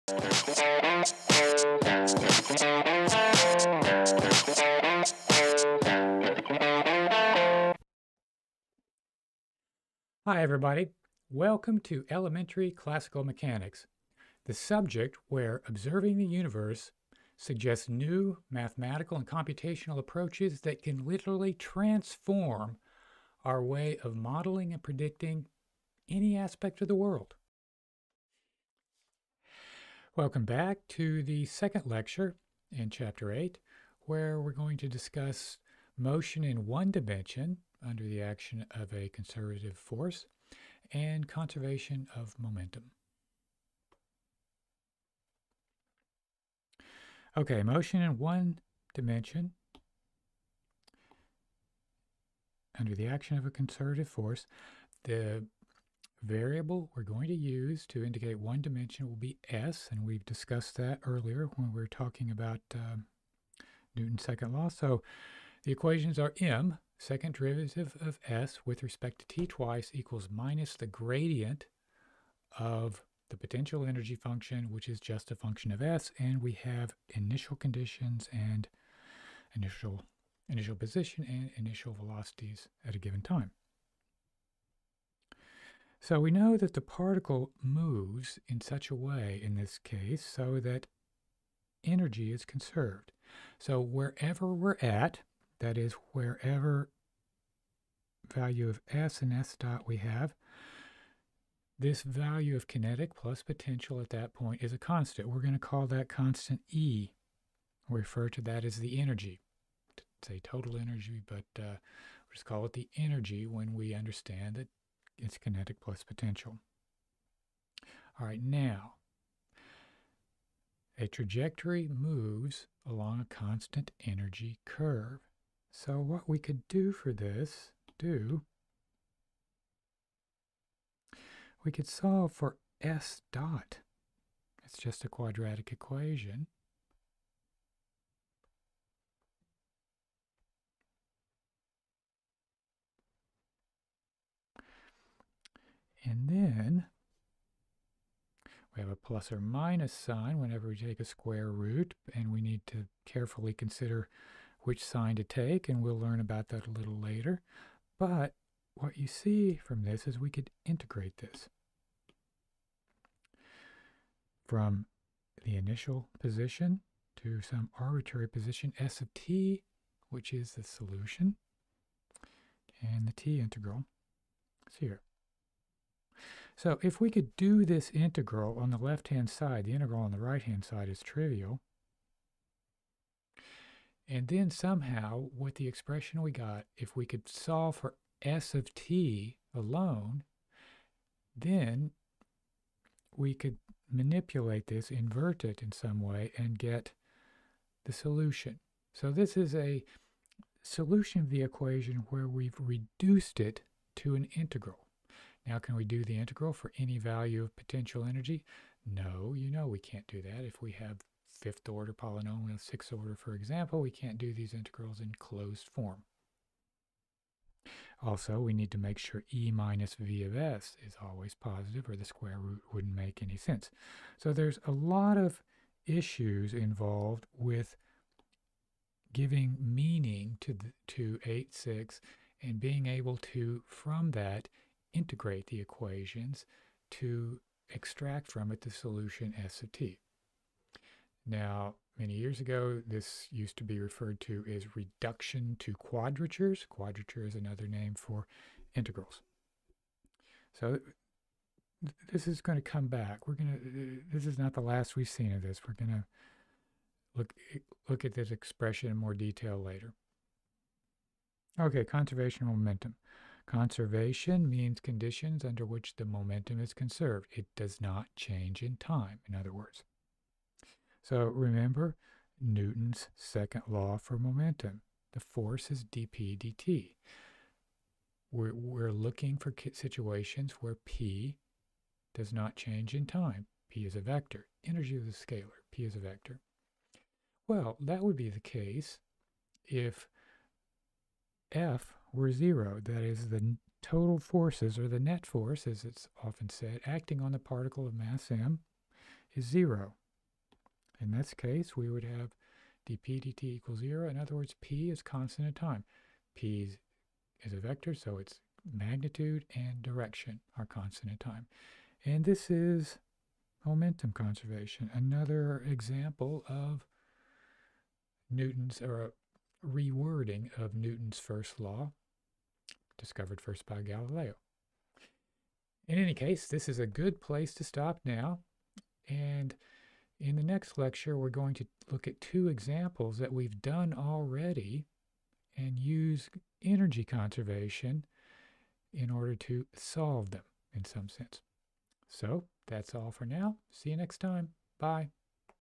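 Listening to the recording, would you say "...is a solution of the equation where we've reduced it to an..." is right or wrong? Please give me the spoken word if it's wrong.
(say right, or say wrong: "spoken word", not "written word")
right.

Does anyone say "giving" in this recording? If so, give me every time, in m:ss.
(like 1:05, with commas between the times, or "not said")
3:49.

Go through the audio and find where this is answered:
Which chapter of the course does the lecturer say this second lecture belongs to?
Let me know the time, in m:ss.
0:32.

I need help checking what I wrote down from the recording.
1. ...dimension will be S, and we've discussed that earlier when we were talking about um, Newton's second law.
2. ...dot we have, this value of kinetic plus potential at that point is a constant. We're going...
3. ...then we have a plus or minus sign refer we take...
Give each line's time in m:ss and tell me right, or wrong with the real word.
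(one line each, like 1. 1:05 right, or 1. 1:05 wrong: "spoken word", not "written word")
1. 0:58 right
2. 1:39 right
3. 2:26 wrong: "whenever", not "refer".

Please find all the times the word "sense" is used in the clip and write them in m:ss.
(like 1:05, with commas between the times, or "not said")
3:43, 5:41.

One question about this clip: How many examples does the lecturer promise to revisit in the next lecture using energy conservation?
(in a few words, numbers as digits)
2.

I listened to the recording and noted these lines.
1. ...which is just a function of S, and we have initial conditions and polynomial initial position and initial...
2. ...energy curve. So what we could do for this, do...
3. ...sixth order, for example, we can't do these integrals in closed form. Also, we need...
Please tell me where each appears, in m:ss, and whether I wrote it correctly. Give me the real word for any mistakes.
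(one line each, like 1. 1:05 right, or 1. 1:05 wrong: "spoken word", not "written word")
1. 1:14 wrong: "initial", not "polynomial"
2. 2:04 right
3. 3:32 right.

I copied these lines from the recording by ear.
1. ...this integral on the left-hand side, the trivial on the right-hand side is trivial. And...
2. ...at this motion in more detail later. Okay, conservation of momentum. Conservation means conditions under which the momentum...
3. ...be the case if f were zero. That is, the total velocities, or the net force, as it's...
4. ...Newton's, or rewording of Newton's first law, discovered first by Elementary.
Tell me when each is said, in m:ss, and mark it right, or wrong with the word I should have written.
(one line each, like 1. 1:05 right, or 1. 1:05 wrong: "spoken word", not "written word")
1. 2:57 wrong: "integral", not "trivial"
2. 4:18 wrong: "expression", not "motion"
3. 4:48 wrong: "forces", not "velocities"
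4. 5:18 wrong: "Galileo", not "Elementary".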